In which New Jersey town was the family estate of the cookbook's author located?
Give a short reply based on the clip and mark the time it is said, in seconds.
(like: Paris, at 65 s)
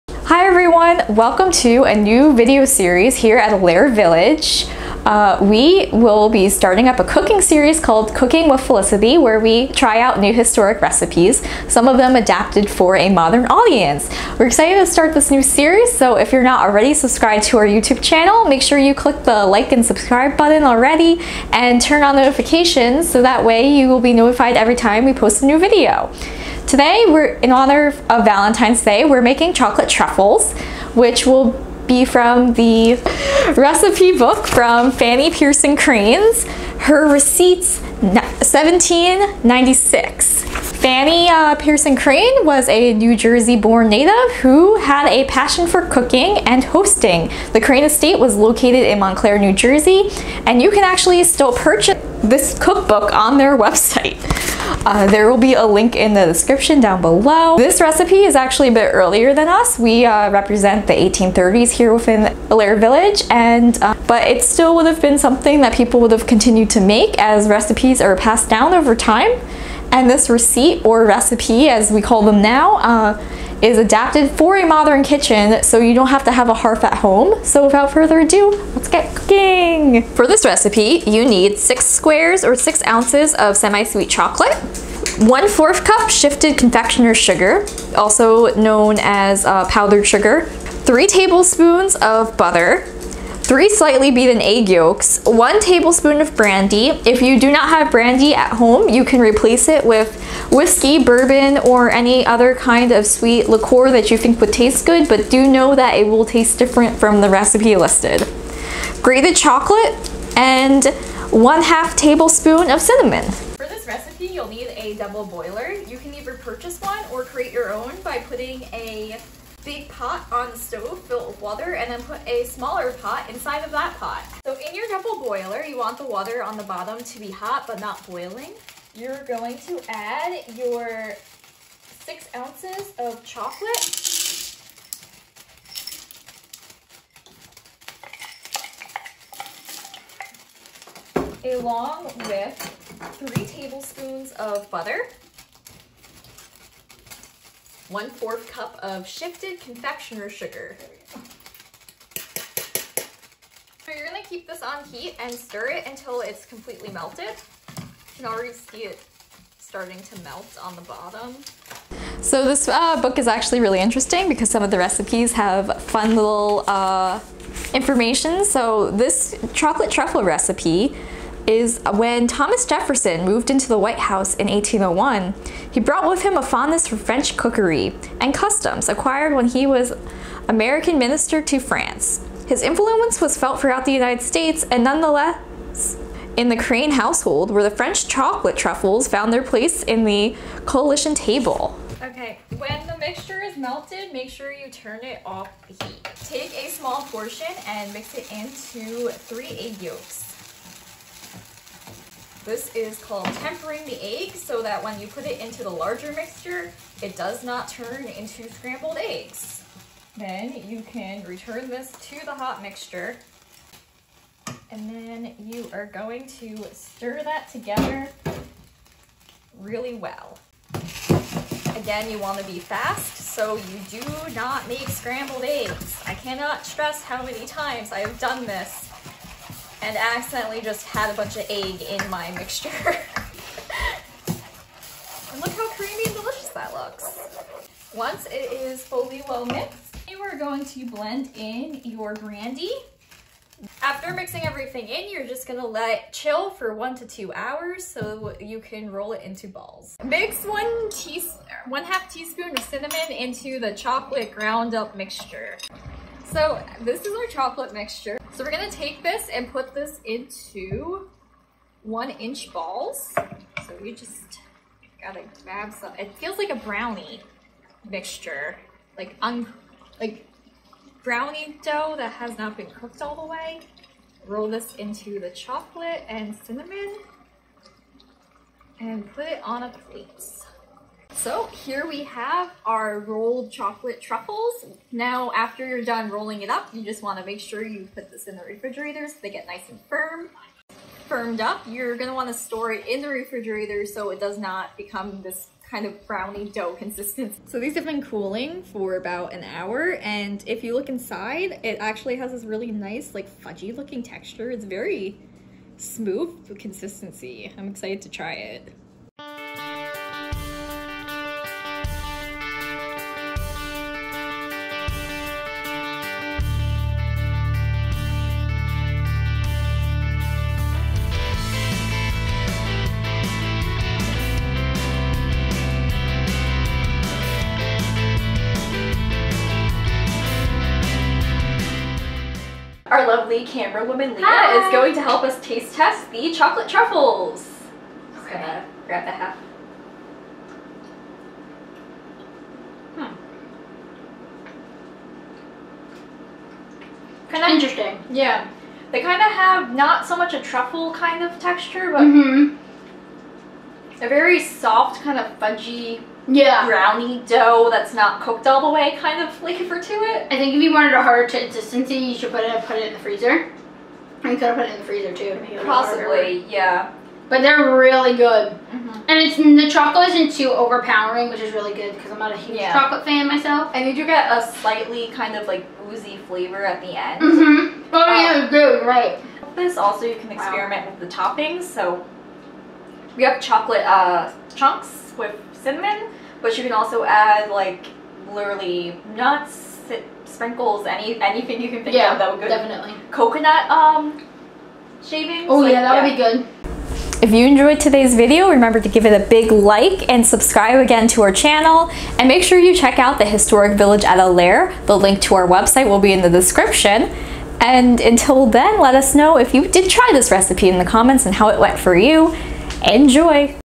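Montclair, at 48 s.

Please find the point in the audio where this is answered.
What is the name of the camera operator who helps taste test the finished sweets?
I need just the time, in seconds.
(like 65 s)
334 s.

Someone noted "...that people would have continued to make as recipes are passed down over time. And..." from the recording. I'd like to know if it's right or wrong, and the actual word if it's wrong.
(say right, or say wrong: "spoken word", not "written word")
right.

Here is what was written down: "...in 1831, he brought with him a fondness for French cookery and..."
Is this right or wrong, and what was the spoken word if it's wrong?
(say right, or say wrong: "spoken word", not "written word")
wrong: "1801", not "1831".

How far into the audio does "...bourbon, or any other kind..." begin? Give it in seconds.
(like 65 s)
101 s.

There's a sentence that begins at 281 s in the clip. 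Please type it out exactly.
So here we have our rolled chocolate truffles.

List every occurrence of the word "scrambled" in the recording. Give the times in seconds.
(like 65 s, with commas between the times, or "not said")
208 s, 224 s.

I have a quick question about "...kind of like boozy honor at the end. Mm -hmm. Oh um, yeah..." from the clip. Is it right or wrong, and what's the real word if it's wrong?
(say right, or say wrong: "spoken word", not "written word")
wrong: "flavor", not "honor".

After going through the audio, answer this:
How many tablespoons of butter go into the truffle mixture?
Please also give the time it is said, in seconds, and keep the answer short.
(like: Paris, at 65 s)
3, at 90 s.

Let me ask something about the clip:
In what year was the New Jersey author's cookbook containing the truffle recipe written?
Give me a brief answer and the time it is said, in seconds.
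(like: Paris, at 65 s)
1796, at 38 s.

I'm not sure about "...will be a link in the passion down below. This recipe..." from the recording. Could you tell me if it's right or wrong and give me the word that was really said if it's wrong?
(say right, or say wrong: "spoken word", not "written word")
wrong: "description", not "passion".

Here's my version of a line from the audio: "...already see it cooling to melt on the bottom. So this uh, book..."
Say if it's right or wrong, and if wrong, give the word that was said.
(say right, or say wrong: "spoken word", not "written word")
wrong: "starting", not "cooling".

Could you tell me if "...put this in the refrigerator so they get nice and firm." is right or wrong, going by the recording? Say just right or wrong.
right.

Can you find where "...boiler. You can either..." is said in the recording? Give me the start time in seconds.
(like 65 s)
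115 s.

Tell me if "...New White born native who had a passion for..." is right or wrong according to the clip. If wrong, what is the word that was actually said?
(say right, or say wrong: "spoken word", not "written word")
wrong: "Jersey", not "White".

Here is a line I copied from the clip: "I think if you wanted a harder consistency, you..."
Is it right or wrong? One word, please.
right.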